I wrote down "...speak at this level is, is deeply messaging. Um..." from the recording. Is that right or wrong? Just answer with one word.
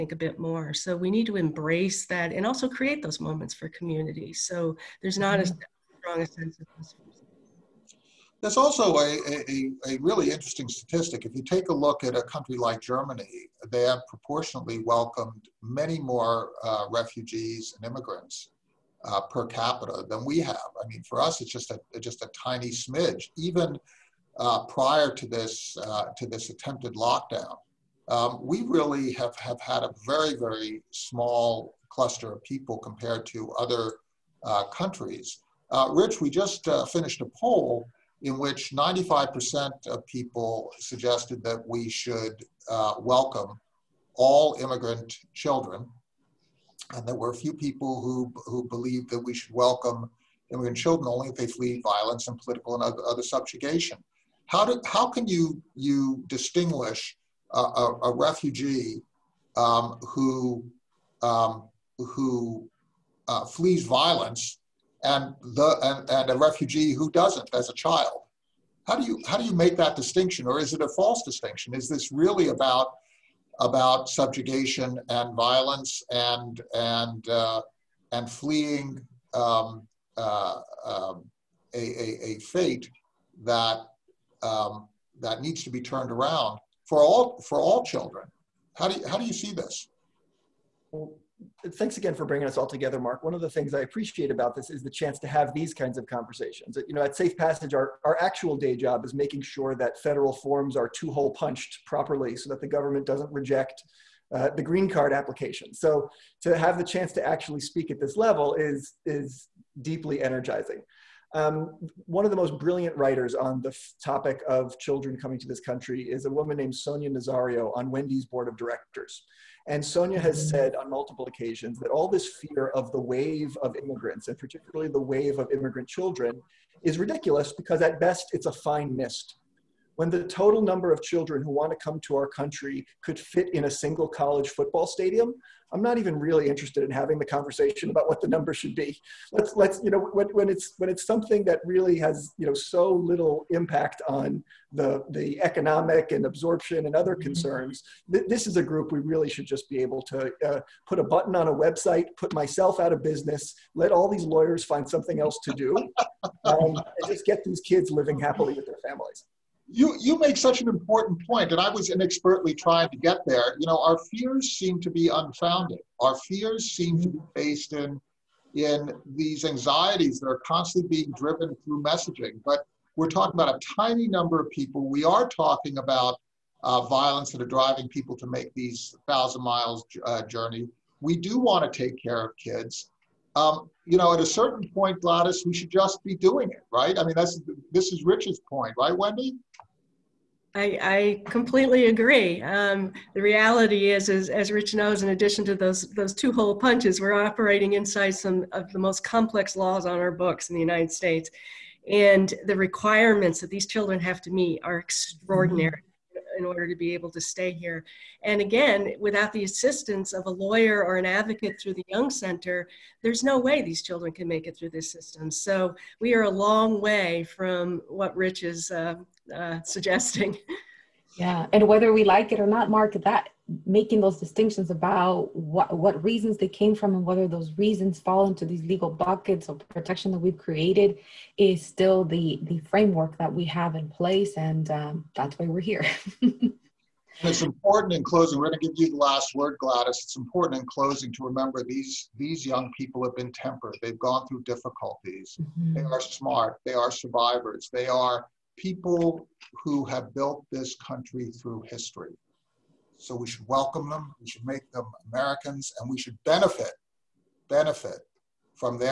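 wrong.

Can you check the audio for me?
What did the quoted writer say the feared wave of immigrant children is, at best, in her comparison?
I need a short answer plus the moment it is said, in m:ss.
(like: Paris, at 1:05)
a fine mist, at 2:08.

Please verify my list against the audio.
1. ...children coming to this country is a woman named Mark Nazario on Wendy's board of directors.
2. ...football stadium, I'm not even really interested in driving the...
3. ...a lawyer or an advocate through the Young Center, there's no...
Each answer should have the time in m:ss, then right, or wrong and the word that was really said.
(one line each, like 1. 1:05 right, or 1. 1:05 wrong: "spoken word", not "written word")
1. 1:54 wrong: "Sonia", not "Mark"
2. 2:14 wrong: "having", not "driving"
3. 3:30 right.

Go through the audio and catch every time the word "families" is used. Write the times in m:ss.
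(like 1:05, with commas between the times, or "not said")
2:38.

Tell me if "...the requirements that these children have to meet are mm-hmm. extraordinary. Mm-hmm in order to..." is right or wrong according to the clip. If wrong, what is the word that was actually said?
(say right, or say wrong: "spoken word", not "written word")
right.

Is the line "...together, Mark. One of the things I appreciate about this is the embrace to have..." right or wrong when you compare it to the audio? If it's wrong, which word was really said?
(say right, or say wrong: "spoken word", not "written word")
wrong: "chance", not "embrace".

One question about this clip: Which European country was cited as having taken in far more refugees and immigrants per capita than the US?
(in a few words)
Germany.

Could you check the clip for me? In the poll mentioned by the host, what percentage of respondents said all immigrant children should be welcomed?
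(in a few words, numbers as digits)
95%.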